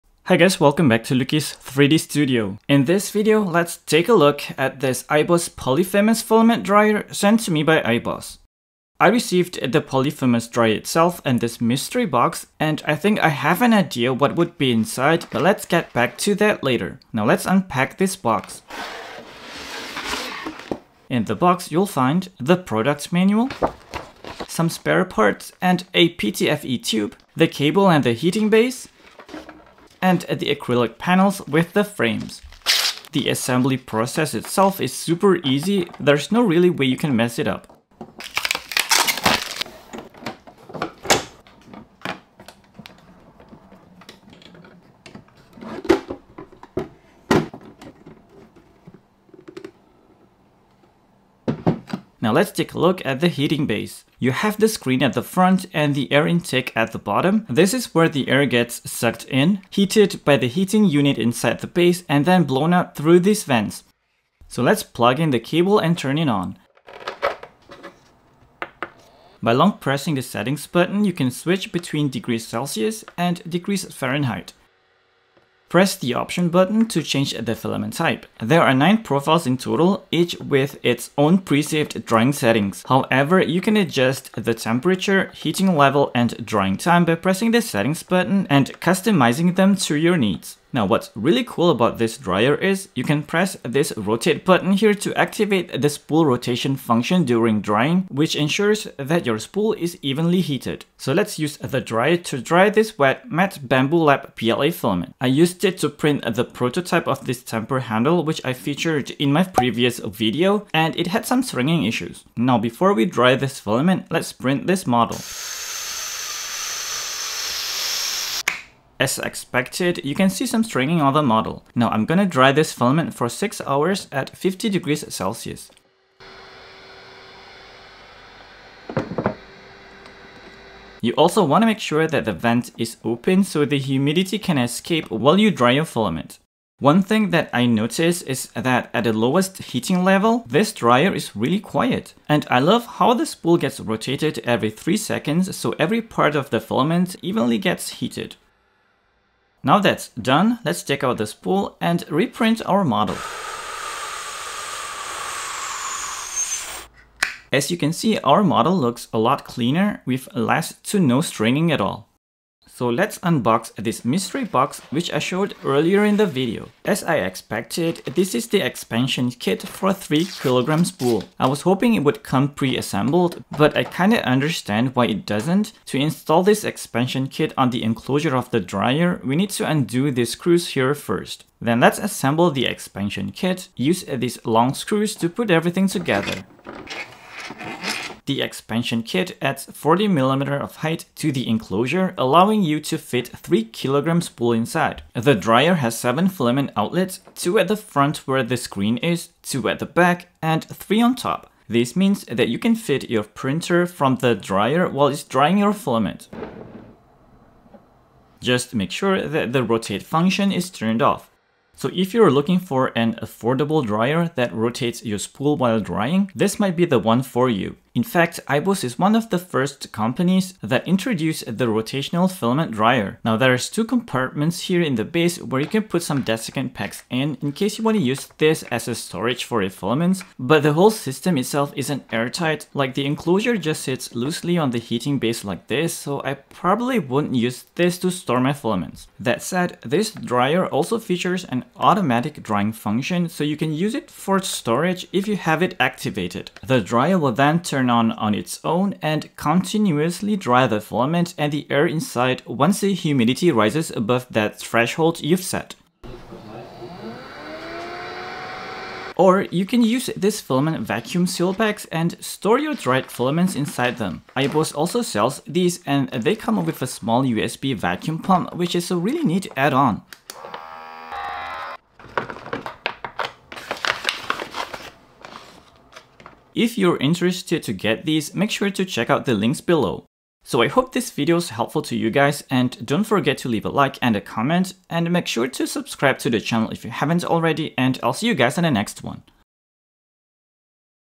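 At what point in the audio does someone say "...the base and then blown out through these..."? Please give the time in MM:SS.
01:01.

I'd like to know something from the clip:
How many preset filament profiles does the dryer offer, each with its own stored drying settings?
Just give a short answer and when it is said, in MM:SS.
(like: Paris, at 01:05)
9, at 01:18.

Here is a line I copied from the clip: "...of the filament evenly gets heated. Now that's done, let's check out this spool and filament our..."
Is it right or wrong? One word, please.
wrong.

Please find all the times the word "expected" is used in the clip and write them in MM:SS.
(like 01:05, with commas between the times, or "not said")
01:59, 02:47.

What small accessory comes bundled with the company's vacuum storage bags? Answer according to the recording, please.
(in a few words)
USB vacuum pump.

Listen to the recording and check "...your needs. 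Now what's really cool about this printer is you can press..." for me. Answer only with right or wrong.
wrong.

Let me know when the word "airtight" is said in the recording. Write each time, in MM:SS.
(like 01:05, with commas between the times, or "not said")
03:52.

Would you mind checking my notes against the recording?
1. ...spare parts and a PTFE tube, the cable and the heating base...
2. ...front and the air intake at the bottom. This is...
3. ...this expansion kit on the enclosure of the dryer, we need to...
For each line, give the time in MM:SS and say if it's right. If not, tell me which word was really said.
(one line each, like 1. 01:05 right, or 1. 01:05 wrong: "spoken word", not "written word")
1. 00:24 right
2. 00:55 right
3. 02:56 right.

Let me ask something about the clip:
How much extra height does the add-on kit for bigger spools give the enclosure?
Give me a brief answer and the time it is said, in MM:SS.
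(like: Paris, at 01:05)
40mm, at 03:09.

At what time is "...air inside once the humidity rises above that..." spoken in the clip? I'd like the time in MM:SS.
04:11.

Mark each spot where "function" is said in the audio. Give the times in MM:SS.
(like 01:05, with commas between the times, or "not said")
01:36, 03:30, 04:02.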